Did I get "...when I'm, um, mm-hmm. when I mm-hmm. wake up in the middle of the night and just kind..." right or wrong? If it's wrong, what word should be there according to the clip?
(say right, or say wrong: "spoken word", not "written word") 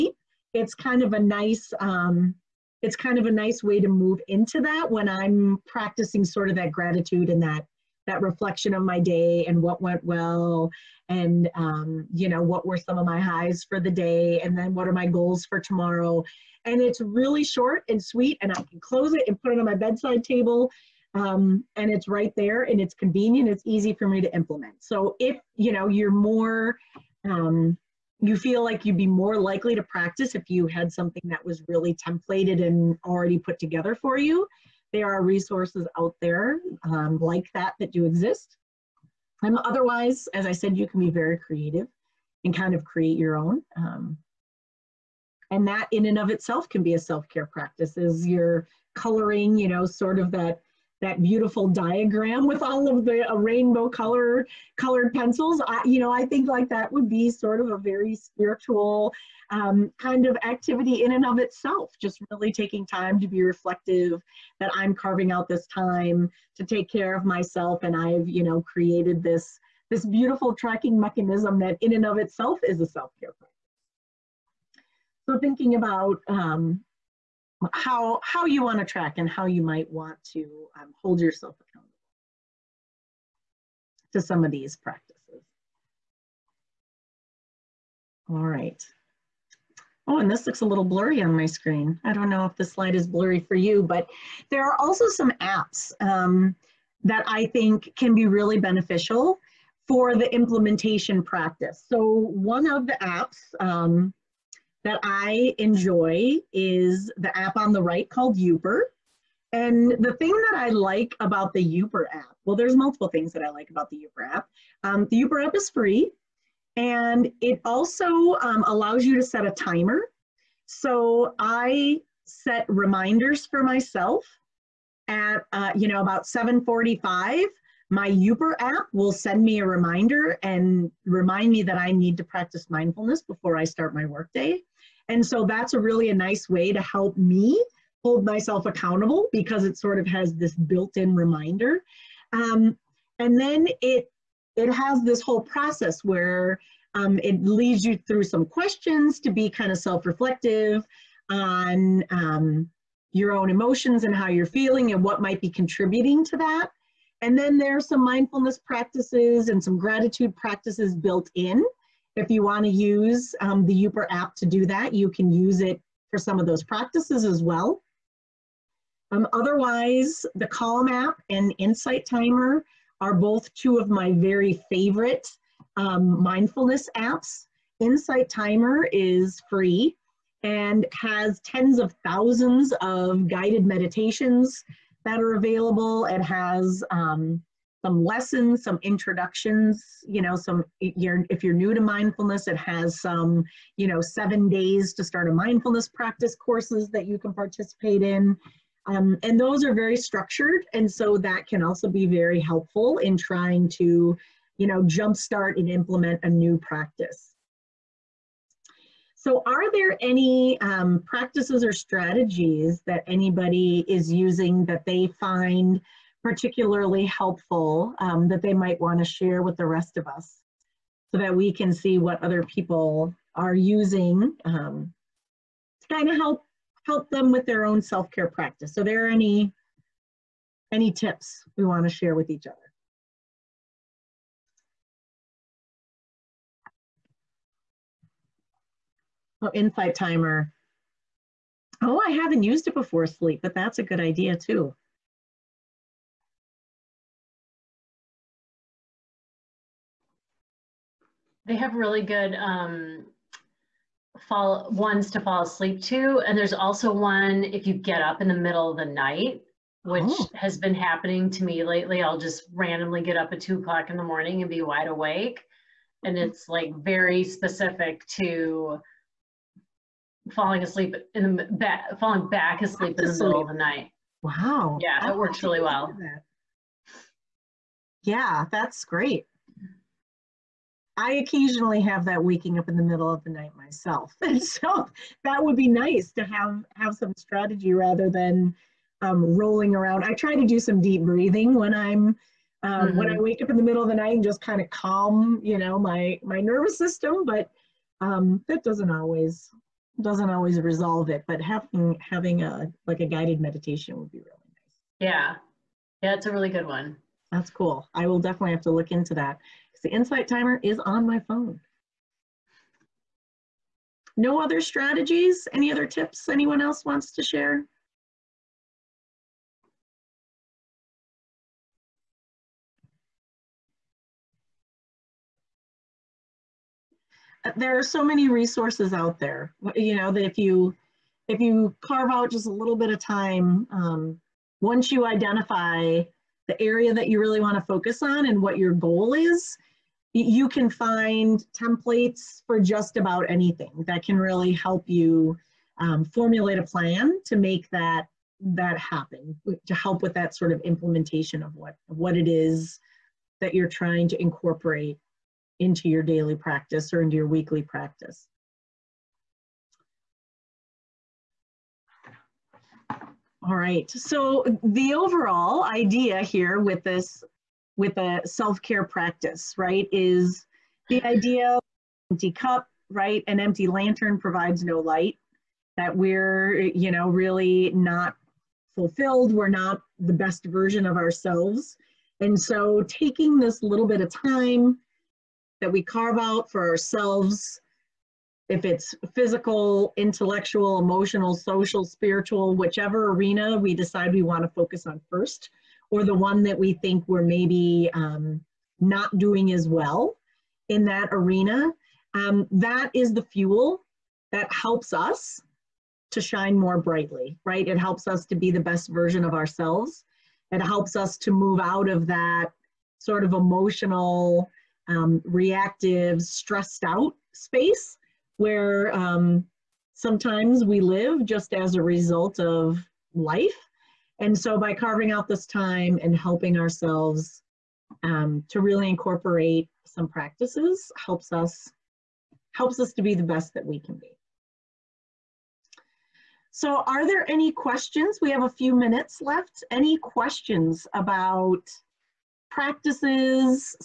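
right.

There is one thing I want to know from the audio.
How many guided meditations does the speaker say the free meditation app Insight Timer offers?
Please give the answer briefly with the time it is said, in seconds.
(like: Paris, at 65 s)
tens of thousands, at 181 s.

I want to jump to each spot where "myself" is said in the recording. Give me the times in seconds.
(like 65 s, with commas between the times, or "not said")
67 s, 123 s, 138 s, 283 s.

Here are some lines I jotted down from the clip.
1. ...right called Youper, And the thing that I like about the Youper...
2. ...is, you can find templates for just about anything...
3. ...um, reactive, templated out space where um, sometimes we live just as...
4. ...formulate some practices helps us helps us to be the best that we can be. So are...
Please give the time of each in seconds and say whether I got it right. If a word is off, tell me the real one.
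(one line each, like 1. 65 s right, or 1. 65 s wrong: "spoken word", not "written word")
1. 107 s right
2. 339 s right
3. 414 s wrong: "stressed", not "templated"
4. 428 s wrong: "incorporate", not "formulate".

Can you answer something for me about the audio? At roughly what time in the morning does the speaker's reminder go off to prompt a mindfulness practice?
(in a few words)
7:45.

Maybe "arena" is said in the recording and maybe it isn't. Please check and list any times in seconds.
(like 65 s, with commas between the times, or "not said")
393 s, 401 s.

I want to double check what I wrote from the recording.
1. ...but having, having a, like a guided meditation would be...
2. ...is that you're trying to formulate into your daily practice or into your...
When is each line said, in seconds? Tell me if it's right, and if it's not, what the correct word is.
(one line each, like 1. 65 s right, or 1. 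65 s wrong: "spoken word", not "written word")
1. 301 s right
2. 352 s wrong: "incorporate", not "formulate".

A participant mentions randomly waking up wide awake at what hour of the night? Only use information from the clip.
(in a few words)
2 o'clock.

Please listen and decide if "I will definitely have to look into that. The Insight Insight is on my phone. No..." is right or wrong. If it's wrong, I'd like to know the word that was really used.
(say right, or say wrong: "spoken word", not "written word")
wrong: "Timer", not "Insight".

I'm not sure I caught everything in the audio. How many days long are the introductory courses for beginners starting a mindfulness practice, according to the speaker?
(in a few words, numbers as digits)
7.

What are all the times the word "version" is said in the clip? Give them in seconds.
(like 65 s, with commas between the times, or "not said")
380 s, 408 s.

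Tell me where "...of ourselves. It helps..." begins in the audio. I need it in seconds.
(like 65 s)
409 s.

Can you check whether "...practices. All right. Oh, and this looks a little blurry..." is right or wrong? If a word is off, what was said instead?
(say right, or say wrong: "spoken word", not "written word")
right.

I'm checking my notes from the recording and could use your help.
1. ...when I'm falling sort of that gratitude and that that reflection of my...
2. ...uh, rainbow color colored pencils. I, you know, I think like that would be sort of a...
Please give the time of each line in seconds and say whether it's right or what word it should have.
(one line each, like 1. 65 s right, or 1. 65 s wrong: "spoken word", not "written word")
1. 4 s wrong: "practicing", not "falling"
2. 53 s right.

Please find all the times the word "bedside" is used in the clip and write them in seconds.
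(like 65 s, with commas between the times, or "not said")
19 s.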